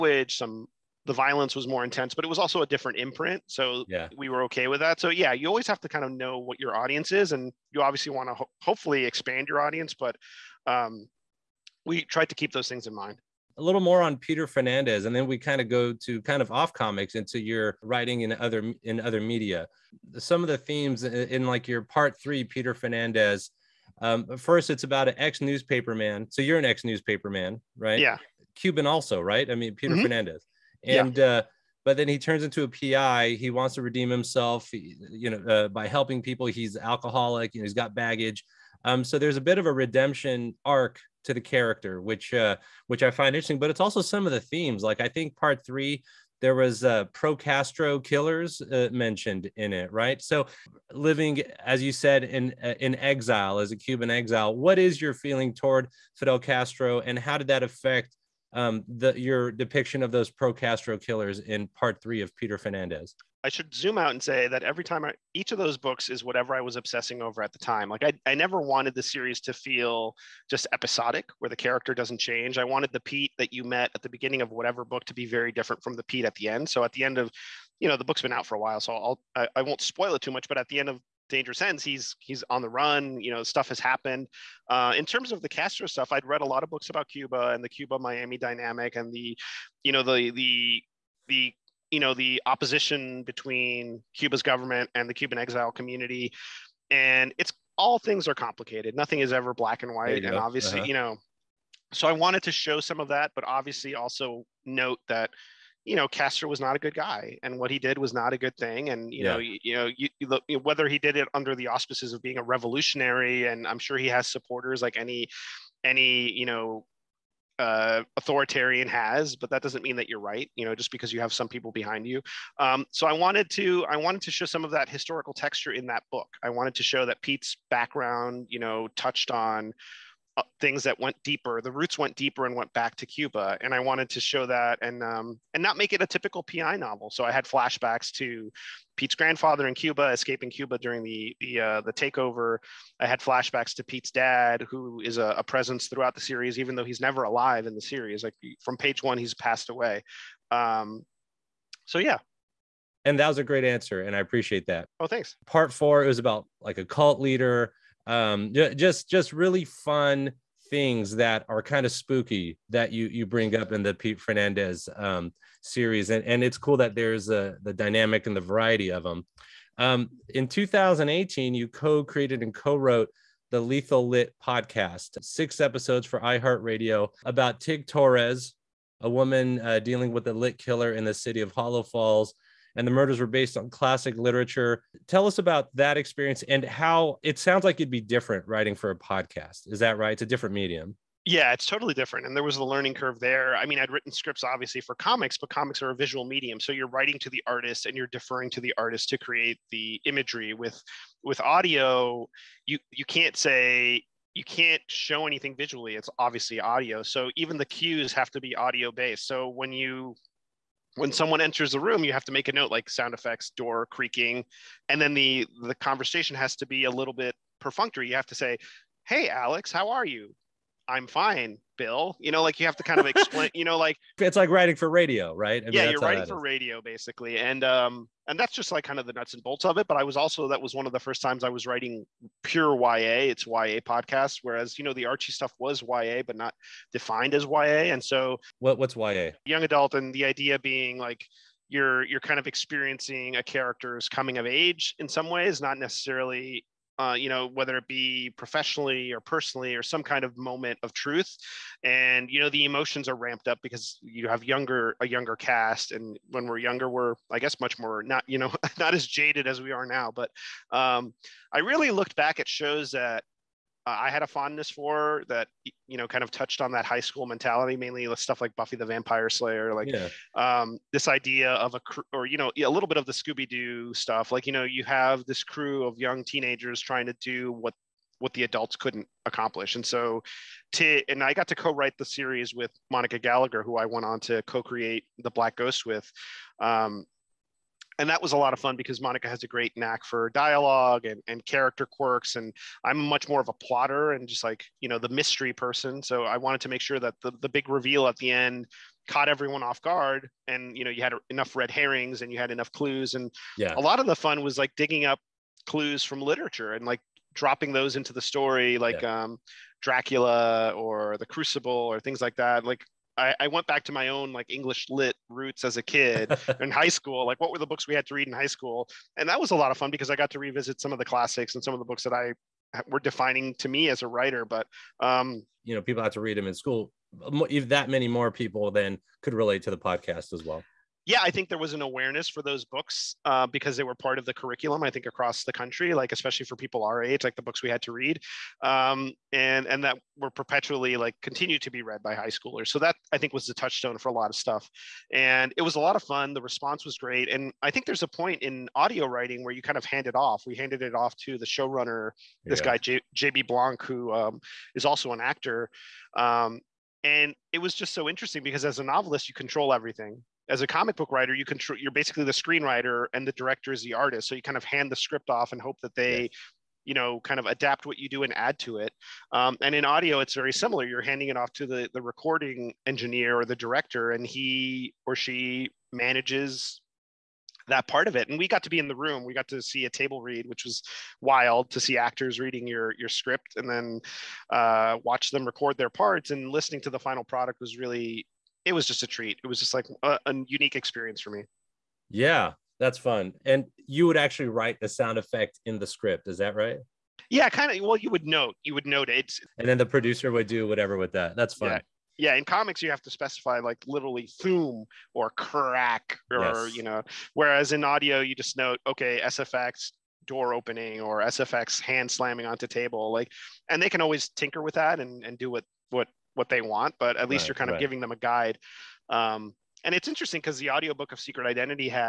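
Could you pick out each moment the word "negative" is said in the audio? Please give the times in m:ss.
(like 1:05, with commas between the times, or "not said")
not said.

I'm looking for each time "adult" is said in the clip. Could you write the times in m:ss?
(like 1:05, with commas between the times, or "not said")
3:59, 4:38.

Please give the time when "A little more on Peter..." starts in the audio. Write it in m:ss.
0:13.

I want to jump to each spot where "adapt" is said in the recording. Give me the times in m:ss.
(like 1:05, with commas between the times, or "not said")
6:07.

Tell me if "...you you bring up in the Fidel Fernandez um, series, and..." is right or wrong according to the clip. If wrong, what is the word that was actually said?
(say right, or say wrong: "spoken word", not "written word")
wrong: "Pete", not "Fidel".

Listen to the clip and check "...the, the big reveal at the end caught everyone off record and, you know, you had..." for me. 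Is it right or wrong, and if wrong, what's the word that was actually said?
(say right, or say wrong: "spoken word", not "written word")
wrong: "guard", not "record".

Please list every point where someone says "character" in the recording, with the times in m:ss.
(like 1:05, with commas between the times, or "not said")
0:41, 1:11, 4:03, 4:51.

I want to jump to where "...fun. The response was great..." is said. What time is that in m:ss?
5:46.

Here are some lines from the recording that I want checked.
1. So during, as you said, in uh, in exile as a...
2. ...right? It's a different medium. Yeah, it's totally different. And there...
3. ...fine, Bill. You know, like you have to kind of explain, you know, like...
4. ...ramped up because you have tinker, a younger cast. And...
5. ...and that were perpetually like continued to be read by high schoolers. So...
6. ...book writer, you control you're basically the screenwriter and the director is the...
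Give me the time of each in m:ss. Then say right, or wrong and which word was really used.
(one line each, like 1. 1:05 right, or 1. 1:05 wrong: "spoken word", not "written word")
1. 0:50 wrong: "living", not "during"
2. 3:09 right
3. 3:41 right
4. 4:13 wrong: "younger", not "tinker"
5. 5:39 right
6. 6:00 right.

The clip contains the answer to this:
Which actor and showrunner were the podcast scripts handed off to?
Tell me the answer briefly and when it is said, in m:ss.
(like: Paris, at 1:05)
JB Blanc, at 5:53.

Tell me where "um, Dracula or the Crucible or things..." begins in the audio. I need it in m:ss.
5:09.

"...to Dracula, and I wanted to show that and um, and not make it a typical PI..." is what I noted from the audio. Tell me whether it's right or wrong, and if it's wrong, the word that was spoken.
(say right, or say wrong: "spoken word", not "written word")
wrong: "Cuba", not "Dracula".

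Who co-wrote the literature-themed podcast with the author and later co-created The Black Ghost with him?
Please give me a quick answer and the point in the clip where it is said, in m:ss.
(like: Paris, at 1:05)
Monica Gallagher, at 4:42.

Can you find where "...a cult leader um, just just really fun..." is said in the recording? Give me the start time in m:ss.
2:36.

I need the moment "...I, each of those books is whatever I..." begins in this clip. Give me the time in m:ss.
1:05.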